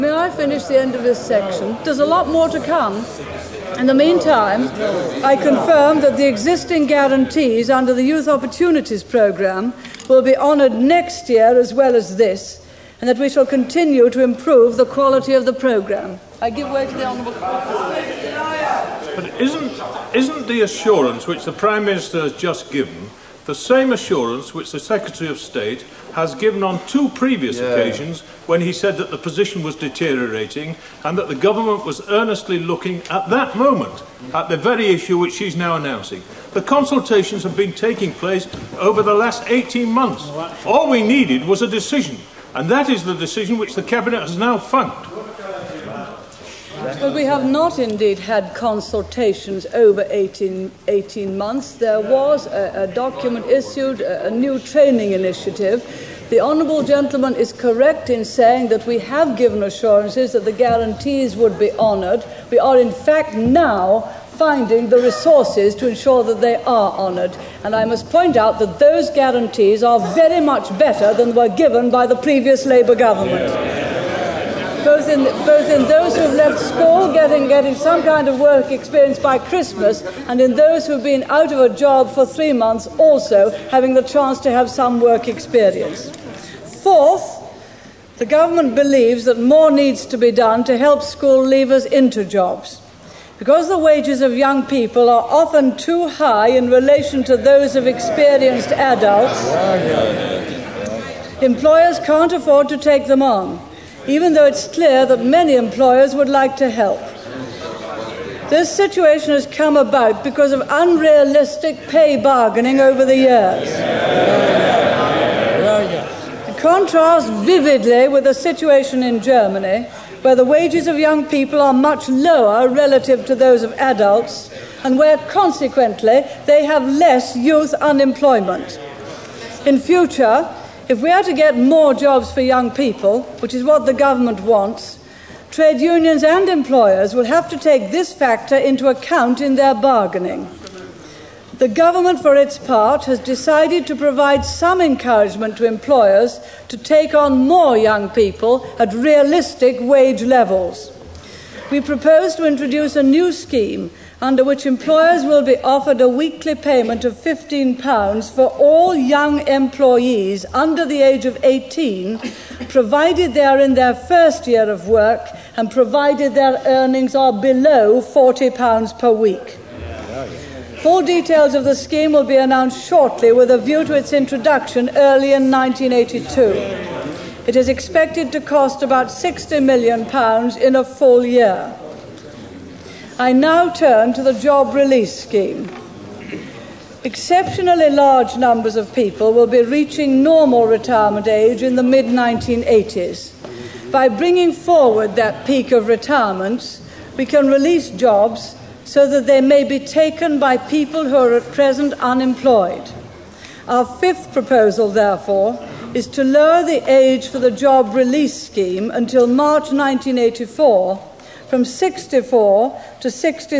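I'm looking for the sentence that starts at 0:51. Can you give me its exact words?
There was a, a document issued, a, a new training initiative.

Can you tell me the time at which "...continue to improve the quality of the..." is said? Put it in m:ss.
0:13.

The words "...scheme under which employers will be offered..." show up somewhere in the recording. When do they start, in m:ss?
2:33.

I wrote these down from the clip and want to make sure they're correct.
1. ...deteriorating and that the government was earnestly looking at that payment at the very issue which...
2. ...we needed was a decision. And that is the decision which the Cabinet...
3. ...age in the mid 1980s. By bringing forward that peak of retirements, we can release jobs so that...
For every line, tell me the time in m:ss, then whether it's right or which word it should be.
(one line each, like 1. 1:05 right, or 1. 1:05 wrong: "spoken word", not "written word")
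1. 0:29 wrong: "moment", not "payment"
2. 0:40 right
3. 3:11 right.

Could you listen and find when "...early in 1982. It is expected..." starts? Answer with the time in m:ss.
2:54.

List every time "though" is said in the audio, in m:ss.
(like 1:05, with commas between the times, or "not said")
1:44.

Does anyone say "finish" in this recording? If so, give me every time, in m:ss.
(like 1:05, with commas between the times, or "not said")
0:00.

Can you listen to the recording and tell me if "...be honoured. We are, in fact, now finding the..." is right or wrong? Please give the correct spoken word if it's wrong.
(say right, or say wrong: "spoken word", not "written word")
right.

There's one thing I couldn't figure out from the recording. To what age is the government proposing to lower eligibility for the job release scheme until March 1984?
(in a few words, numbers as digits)
63.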